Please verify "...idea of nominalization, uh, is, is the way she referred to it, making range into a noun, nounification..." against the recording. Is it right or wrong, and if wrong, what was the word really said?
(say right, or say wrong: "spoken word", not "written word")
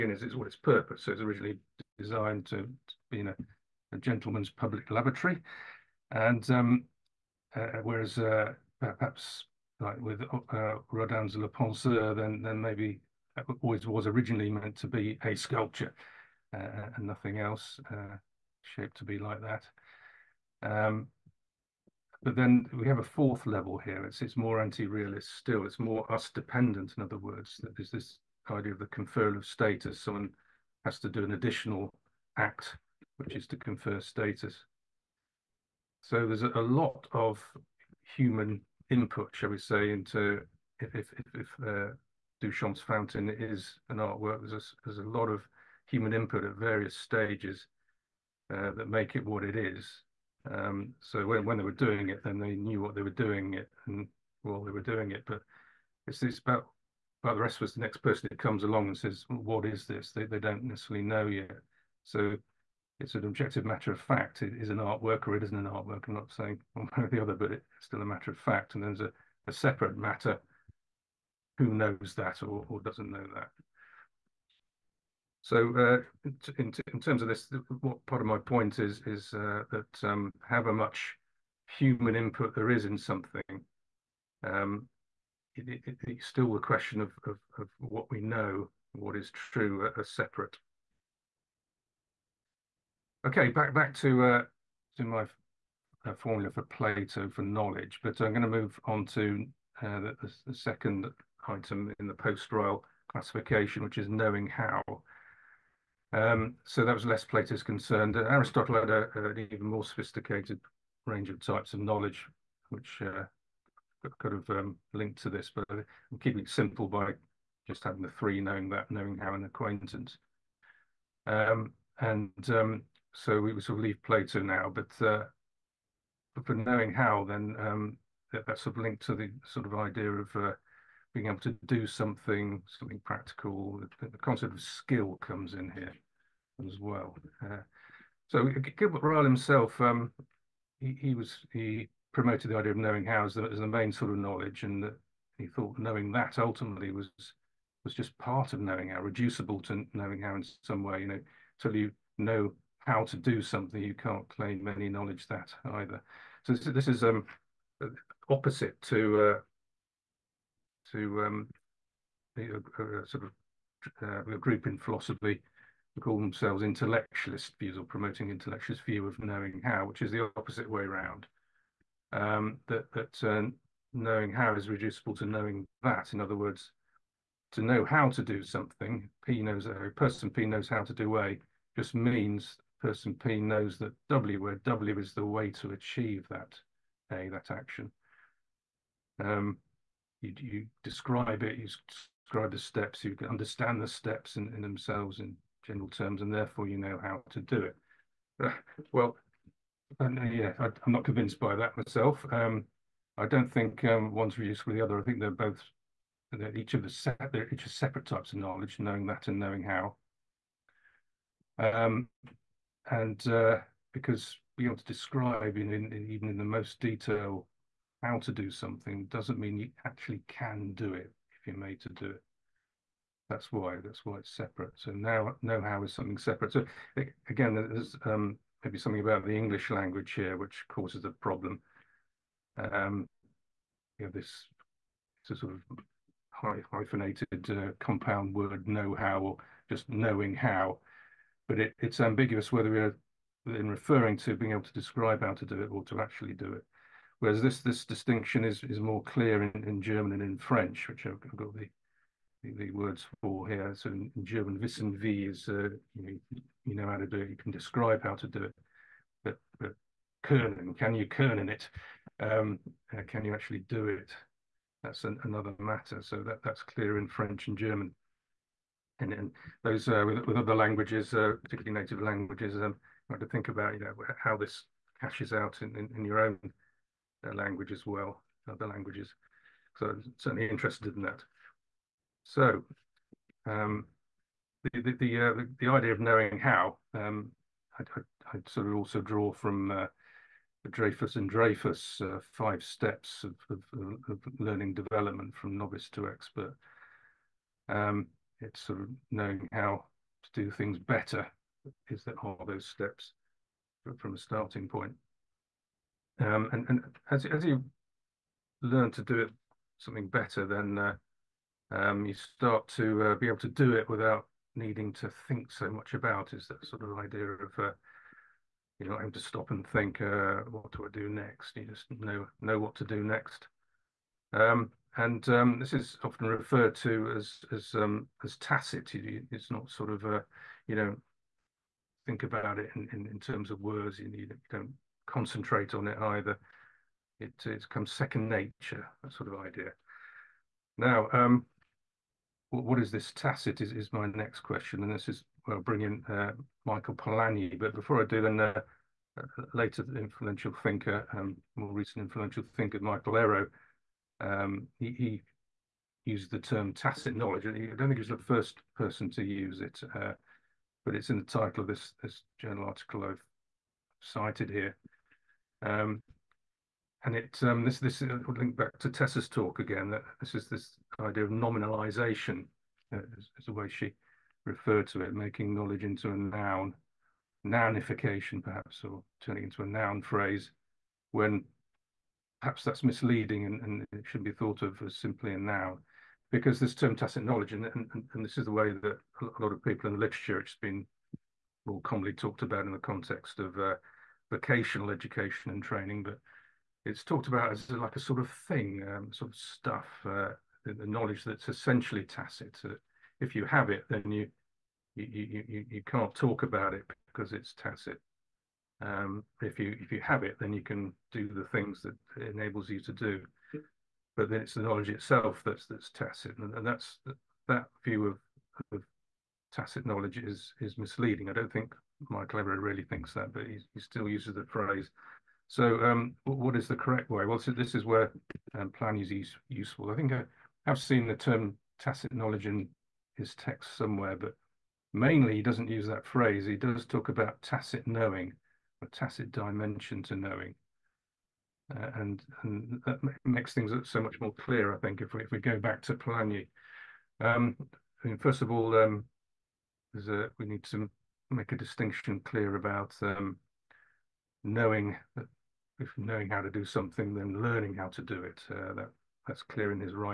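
wrong: "knowledge", not "range".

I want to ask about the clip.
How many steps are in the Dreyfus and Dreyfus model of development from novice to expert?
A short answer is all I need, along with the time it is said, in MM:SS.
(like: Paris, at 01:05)
5, at 04:52.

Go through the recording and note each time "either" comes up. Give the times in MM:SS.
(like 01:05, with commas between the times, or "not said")
02:35, 05:36.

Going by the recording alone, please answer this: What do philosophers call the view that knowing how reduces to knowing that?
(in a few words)
intellectualist view.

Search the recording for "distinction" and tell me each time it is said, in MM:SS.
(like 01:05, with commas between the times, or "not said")
04:07, 07:31.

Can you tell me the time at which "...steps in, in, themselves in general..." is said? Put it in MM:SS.
03:13.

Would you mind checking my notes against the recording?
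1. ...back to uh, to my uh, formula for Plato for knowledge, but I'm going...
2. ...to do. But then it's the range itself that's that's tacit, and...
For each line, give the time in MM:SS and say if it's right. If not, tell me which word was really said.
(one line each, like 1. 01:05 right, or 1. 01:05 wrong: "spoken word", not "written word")
1. 01:33 right
2. 06:52 wrong: "knowledge", not "range".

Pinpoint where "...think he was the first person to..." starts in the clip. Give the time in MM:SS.
05:57.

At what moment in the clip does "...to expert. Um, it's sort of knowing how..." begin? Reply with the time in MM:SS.
04:55.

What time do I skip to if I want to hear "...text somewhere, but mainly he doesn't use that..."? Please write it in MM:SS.
07:13.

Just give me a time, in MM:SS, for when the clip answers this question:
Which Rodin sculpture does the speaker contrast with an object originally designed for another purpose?
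00:11.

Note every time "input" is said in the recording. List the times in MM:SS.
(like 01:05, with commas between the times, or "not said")
00:38, 00:46, 01:22.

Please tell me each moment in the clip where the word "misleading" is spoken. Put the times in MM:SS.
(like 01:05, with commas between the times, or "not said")
06:22, 07:00.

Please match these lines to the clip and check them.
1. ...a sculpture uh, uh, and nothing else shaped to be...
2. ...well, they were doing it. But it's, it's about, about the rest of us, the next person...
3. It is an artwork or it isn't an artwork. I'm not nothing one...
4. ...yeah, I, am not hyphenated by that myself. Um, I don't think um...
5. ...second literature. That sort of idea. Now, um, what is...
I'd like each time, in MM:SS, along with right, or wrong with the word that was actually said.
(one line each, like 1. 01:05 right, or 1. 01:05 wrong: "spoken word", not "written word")
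1. 00:15 right
2. 00:54 right
3. 01:04 wrong: "saying", not "nothing"
4. 03:20 wrong: "convinced", not "hyphenated"
5. 05:37 wrong: "nature", not "literature".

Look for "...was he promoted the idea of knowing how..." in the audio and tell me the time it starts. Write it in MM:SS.
02:21.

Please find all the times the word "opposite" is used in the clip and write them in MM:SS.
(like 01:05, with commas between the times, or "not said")
02:38, 02:50.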